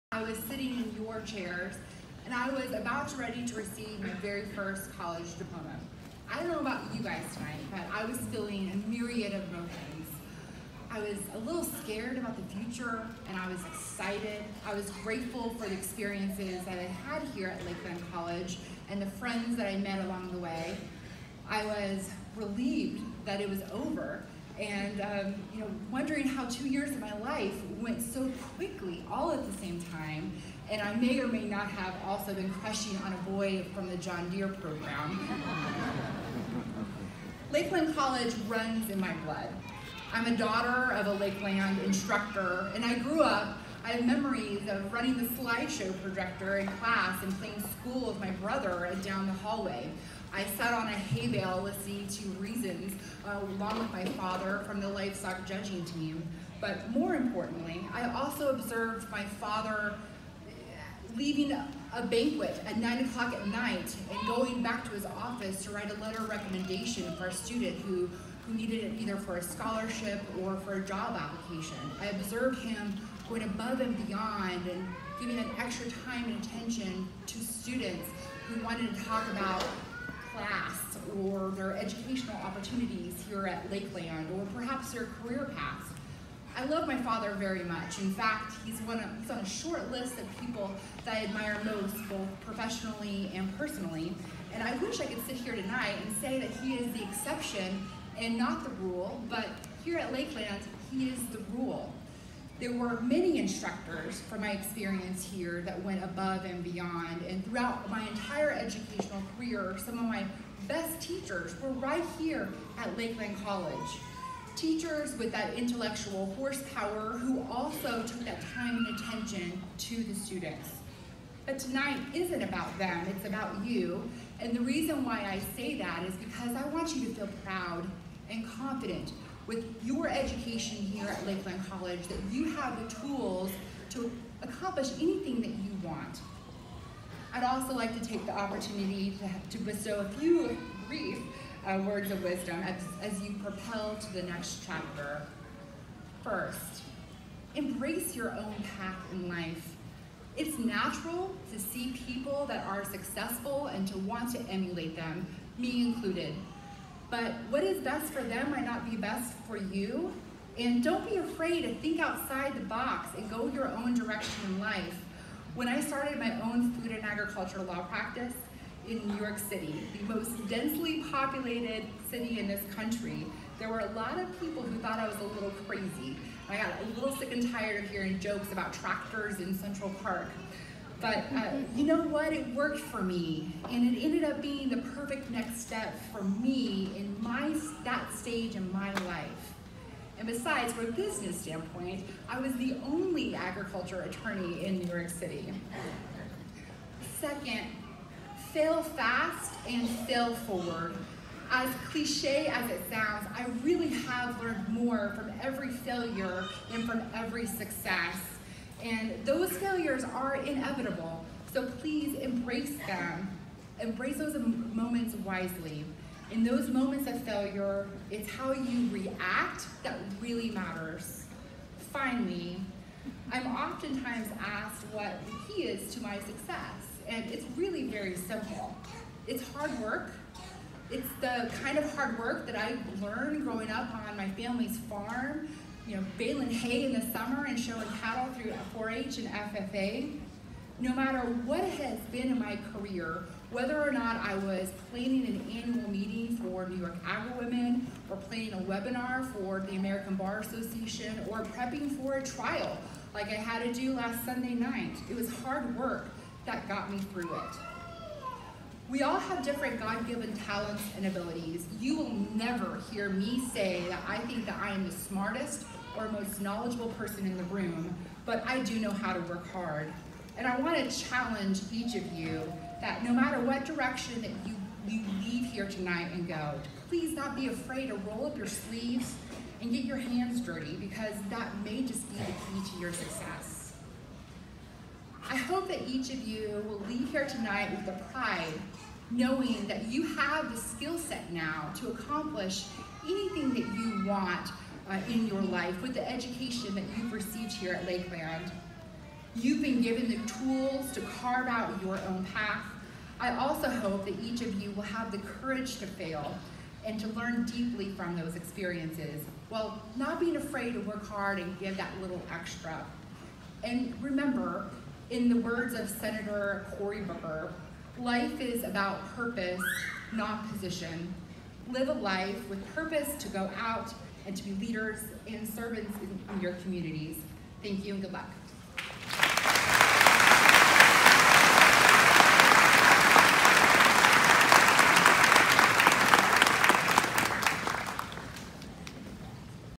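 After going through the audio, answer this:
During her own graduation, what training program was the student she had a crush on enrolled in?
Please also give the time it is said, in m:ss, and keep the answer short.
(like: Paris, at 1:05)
John Deere program, at 0:33.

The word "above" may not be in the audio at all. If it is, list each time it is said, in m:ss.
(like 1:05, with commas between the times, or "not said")
1:13, 1:46.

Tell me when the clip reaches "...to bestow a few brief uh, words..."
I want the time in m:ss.
2:19.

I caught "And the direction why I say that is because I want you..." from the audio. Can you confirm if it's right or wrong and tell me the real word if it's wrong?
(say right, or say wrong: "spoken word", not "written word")
wrong: "reason", not "direction".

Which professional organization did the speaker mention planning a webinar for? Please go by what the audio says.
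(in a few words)
American Bar Association.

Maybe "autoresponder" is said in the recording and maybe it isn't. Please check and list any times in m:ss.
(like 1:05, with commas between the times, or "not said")
not said.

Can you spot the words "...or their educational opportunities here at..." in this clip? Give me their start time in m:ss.
1:21.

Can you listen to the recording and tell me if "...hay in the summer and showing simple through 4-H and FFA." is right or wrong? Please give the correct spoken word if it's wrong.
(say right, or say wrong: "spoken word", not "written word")
wrong: "cattle", not "simple".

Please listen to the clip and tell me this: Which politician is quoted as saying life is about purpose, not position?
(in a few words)
Cory Booker.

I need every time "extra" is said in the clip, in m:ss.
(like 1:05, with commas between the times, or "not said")
1:15, 5:12.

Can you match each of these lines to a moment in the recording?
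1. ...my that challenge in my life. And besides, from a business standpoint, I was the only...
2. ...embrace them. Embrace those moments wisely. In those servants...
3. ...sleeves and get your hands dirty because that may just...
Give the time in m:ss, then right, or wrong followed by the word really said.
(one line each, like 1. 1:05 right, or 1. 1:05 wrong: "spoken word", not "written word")
1. 3:07 wrong: "stage", not "challenge"
2. 3:32 wrong: "moments", not "servants"
3. 4:38 right.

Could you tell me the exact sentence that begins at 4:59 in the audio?
You've been given the tools to carve out your own path.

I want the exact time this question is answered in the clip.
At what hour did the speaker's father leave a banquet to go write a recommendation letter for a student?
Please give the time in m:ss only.
1:02.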